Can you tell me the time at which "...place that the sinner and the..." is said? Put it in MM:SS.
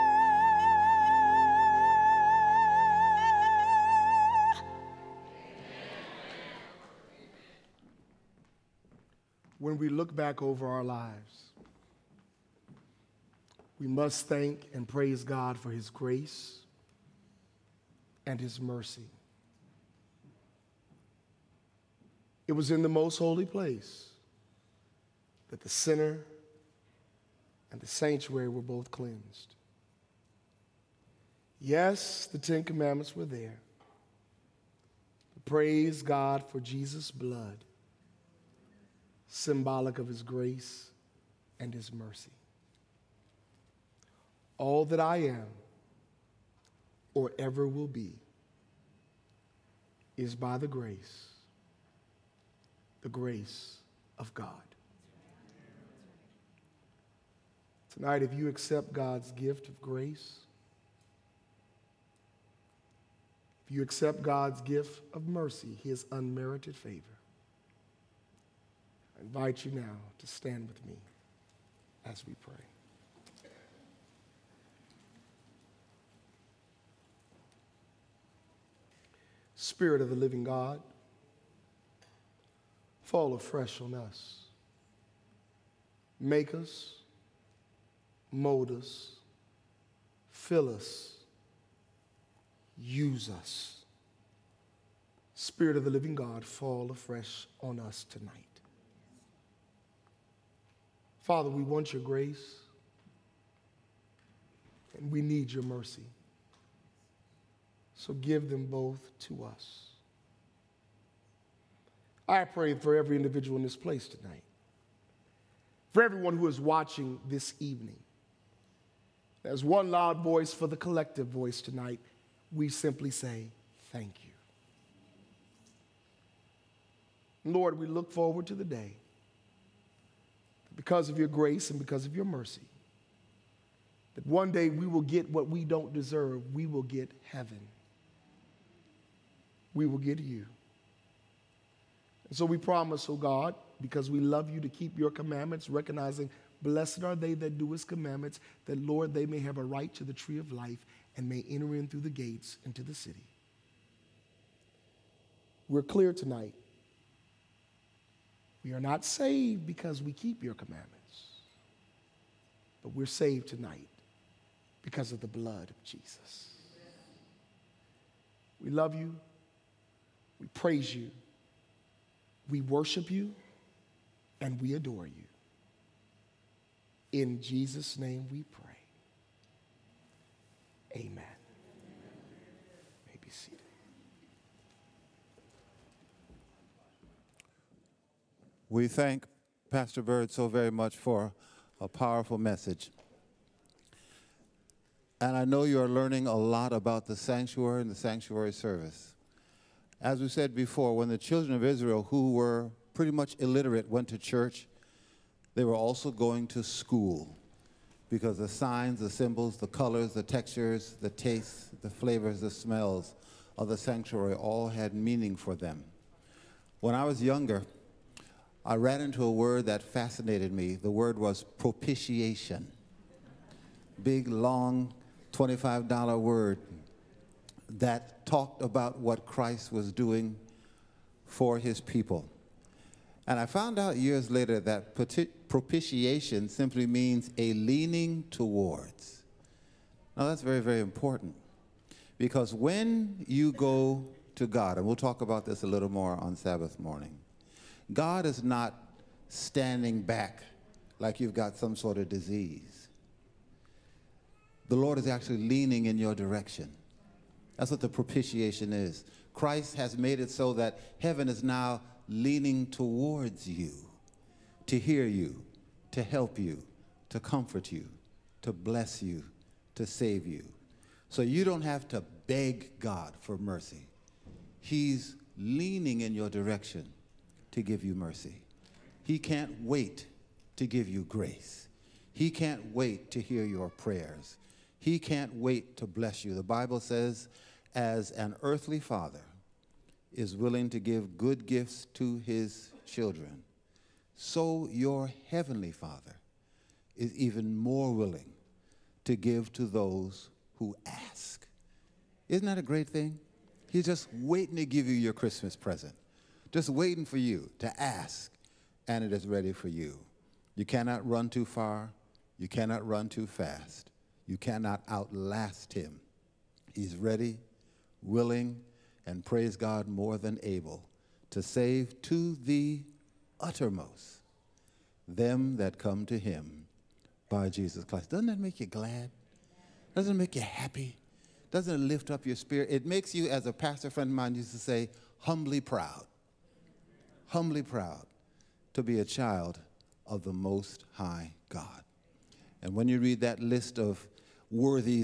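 00:23.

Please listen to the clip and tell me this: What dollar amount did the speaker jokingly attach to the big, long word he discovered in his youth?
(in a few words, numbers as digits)
$25.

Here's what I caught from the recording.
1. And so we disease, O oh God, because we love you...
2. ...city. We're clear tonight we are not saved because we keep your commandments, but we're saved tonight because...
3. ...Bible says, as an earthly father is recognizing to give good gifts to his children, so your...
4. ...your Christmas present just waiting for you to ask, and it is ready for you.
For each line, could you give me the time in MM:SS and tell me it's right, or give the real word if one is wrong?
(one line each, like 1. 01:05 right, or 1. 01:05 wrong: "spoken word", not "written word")
1. 02:22 wrong: "promise", not "disease"
2. 02:32 right
3. 04:46 wrong: "willing", not "recognizing"
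4. 05:04 right.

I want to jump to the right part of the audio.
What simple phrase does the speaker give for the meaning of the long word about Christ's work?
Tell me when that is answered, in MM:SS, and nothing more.
03:57.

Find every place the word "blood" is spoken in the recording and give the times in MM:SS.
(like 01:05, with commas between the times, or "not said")
00:37, 02:45.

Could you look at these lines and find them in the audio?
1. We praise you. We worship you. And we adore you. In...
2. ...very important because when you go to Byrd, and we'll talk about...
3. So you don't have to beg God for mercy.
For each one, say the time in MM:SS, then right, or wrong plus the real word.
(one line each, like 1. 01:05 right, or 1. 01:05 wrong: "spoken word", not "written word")
1. 02:50 right
2. 04:00 wrong: "God", not "Byrd"
3. 04:31 right.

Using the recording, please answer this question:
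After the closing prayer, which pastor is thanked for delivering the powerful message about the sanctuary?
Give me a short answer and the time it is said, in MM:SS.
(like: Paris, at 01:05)
Pastor Byrd, at 03:09.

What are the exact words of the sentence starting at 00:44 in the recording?
All that I am or ever will be is by the grace, the grace of God.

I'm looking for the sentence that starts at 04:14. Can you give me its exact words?
The Lord is actually leaning in your direction.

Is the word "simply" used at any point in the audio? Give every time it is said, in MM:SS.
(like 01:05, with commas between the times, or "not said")
02:02, 03:56.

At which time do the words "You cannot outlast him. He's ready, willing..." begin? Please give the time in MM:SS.
05:14.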